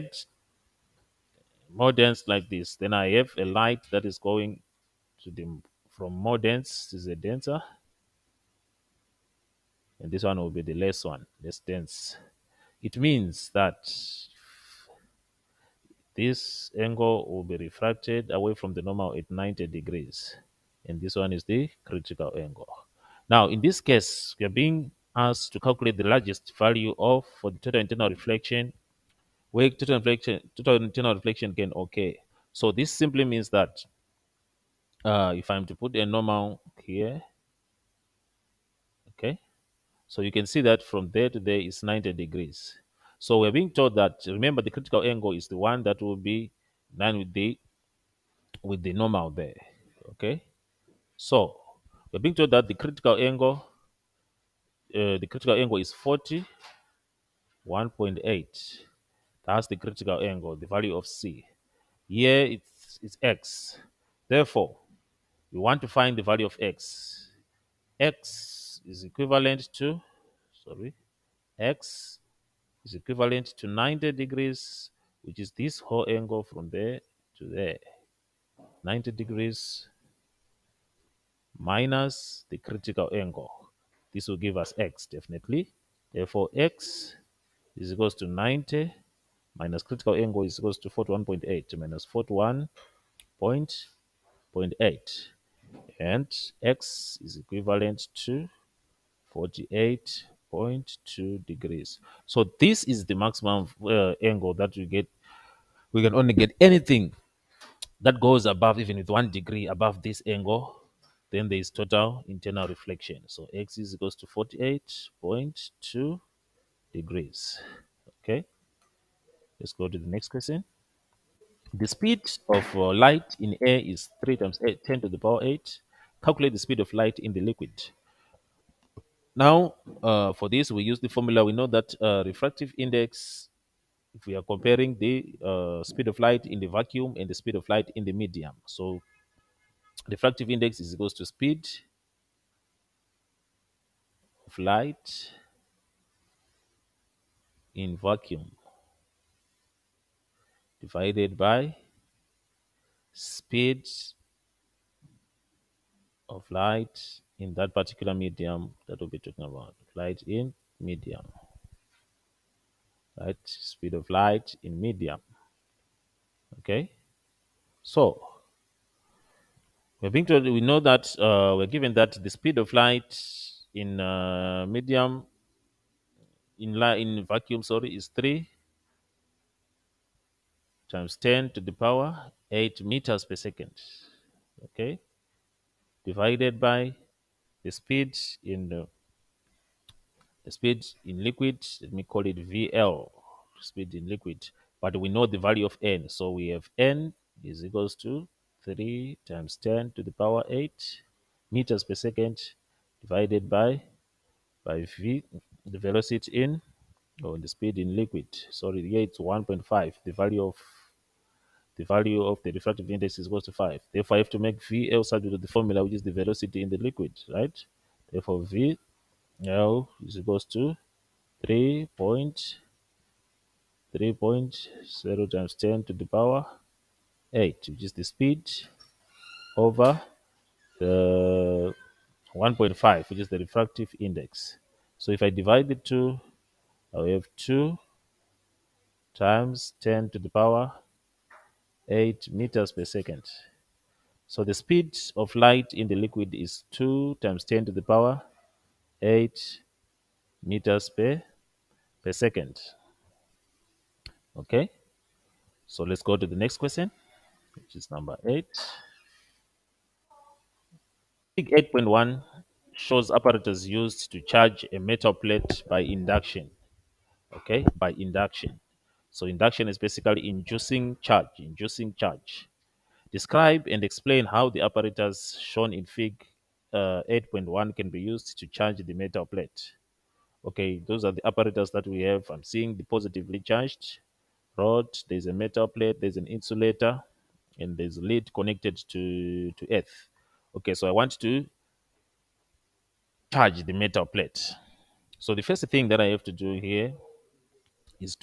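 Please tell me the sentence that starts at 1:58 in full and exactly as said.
Okay, let's go to the next question.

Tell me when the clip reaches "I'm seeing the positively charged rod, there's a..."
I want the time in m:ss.
4:42.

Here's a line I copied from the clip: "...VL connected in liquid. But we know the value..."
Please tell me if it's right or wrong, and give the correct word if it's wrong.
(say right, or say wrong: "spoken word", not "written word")
wrong: "speed", not "connected".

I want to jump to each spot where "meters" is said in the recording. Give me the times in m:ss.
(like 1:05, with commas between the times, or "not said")
3:02, 3:21, 4:02, 4:10.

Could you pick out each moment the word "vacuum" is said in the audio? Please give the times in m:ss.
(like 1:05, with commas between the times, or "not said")
2:16, 2:27, 2:57.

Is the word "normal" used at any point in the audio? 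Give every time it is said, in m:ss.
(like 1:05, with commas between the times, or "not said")
0:18, 0:36, 0:48.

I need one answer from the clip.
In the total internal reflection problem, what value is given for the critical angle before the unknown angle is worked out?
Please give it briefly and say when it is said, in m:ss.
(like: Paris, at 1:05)
41.8 degrees, at 0:55.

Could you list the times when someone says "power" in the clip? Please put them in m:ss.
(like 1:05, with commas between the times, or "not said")
2:05, 3:01, 3:20, 3:46, 4:00, 4:07.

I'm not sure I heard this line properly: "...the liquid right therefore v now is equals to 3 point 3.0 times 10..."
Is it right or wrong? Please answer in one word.
right.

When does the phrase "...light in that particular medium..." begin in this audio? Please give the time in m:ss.
2:36.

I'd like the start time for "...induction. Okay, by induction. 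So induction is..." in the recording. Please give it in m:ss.
4:25.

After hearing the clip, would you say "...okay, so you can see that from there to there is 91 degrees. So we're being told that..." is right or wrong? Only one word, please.
wrong.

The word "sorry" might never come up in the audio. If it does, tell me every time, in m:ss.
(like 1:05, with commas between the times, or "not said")
1:10, 2:57, 3:28.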